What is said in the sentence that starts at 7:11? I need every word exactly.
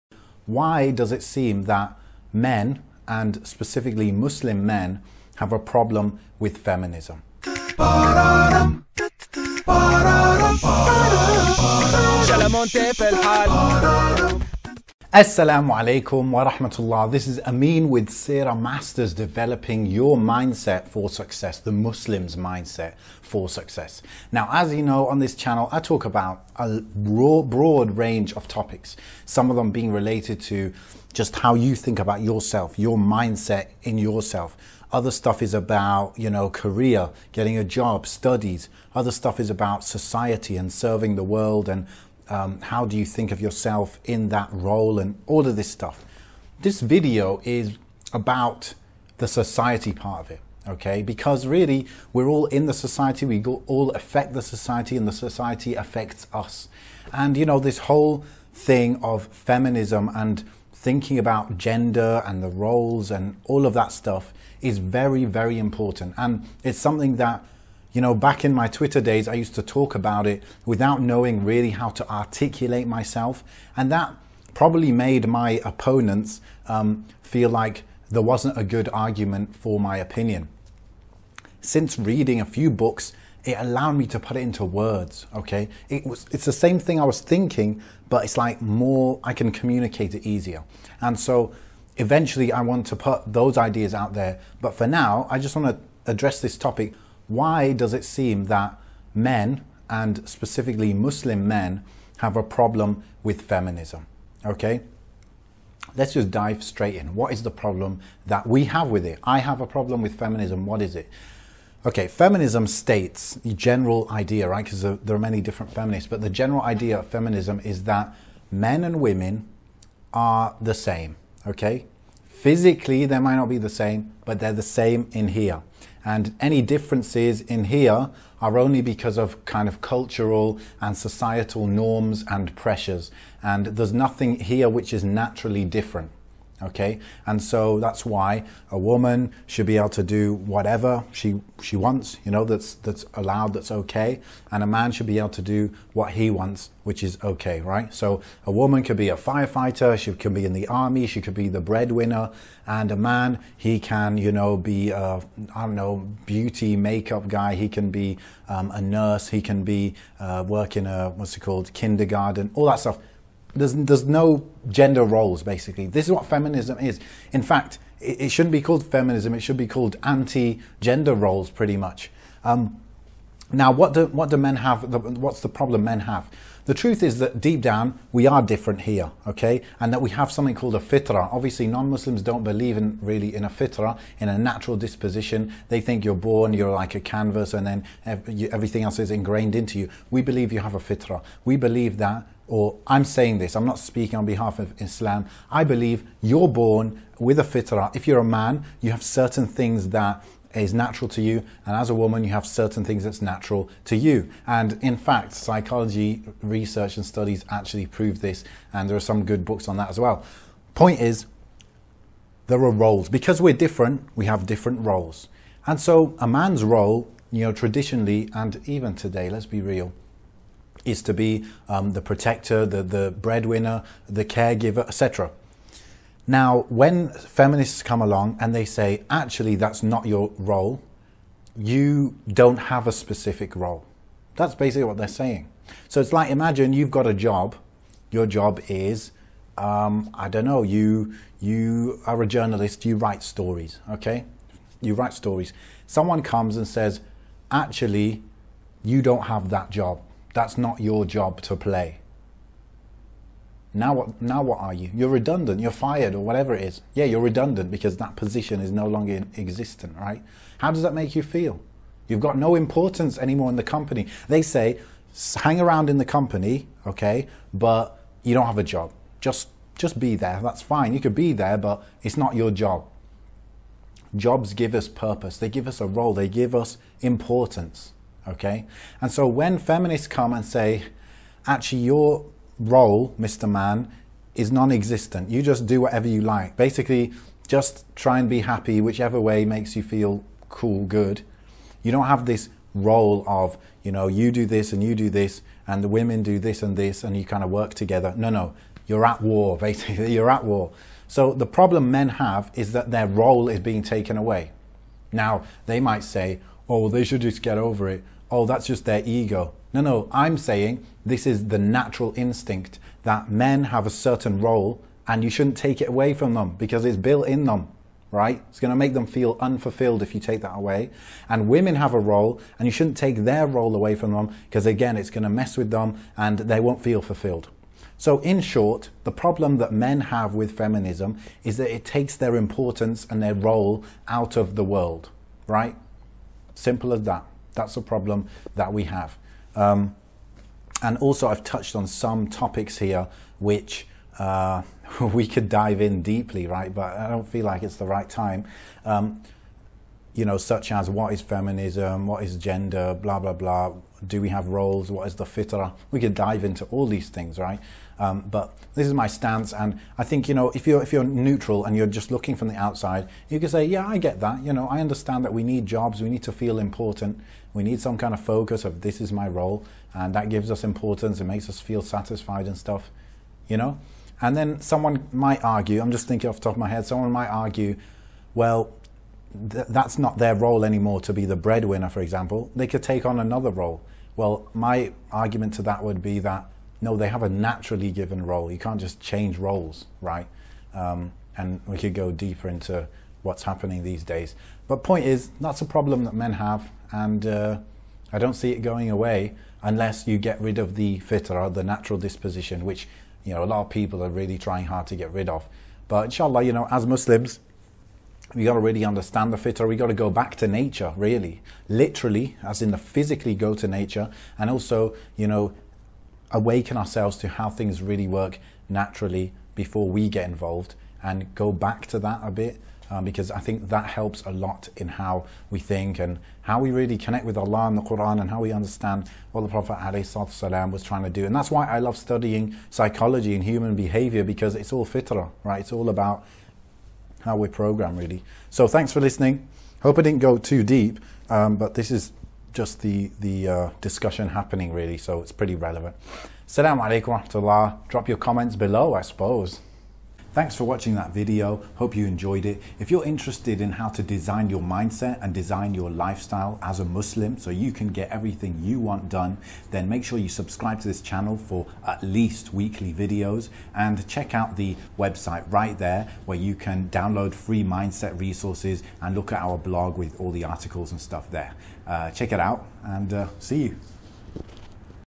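And that's why I love studying psychology and human behavior because it's all fitrah, right?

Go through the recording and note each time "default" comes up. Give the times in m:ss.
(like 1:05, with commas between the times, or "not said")
not said.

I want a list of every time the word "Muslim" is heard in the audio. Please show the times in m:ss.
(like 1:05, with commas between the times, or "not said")
0:04, 0:21, 1:40, 3:01, 6:46, 7:36.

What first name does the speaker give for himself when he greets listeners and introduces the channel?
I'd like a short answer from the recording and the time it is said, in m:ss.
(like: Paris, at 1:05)
Ameen, at 0:17.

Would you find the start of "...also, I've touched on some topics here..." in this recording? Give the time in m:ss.
5:40.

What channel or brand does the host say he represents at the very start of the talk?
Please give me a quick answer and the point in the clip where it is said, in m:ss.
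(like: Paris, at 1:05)
Seera Masters, at 0:18.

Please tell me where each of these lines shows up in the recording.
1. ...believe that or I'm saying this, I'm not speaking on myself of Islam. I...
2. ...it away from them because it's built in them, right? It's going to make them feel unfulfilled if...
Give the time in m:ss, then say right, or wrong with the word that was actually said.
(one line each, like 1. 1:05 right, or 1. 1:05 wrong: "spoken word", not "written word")
1. 3:11 wrong: "behalf", not "myself"
2. 5:15 right.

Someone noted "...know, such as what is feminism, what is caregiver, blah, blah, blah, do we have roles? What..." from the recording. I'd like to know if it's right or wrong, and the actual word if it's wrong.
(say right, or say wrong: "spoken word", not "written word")
wrong: "gender", not "caregiver".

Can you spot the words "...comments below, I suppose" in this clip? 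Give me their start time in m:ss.
7:28.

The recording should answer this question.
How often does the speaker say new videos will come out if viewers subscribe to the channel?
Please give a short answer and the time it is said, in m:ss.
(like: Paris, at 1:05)
Weekly, at 7:42.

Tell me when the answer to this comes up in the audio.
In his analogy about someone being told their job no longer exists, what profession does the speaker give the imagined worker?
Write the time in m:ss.
4:02.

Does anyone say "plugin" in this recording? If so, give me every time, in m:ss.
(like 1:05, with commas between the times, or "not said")
not said.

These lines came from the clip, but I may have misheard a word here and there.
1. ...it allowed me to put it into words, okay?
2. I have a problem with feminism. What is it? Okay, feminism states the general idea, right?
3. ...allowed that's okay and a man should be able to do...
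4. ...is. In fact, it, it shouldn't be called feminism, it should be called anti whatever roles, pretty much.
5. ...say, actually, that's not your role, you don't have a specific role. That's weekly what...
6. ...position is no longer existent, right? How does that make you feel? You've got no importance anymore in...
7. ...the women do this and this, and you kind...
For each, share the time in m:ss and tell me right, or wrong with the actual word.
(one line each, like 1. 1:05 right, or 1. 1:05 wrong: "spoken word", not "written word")
1. 1:23 right
2. 1:49 right
3. 2:23 right
4. 2:46 wrong: "gender", not "whatever"
5. 3:48 wrong: "basically", not "weekly"
6. 4:18 right
7. 4:55 right.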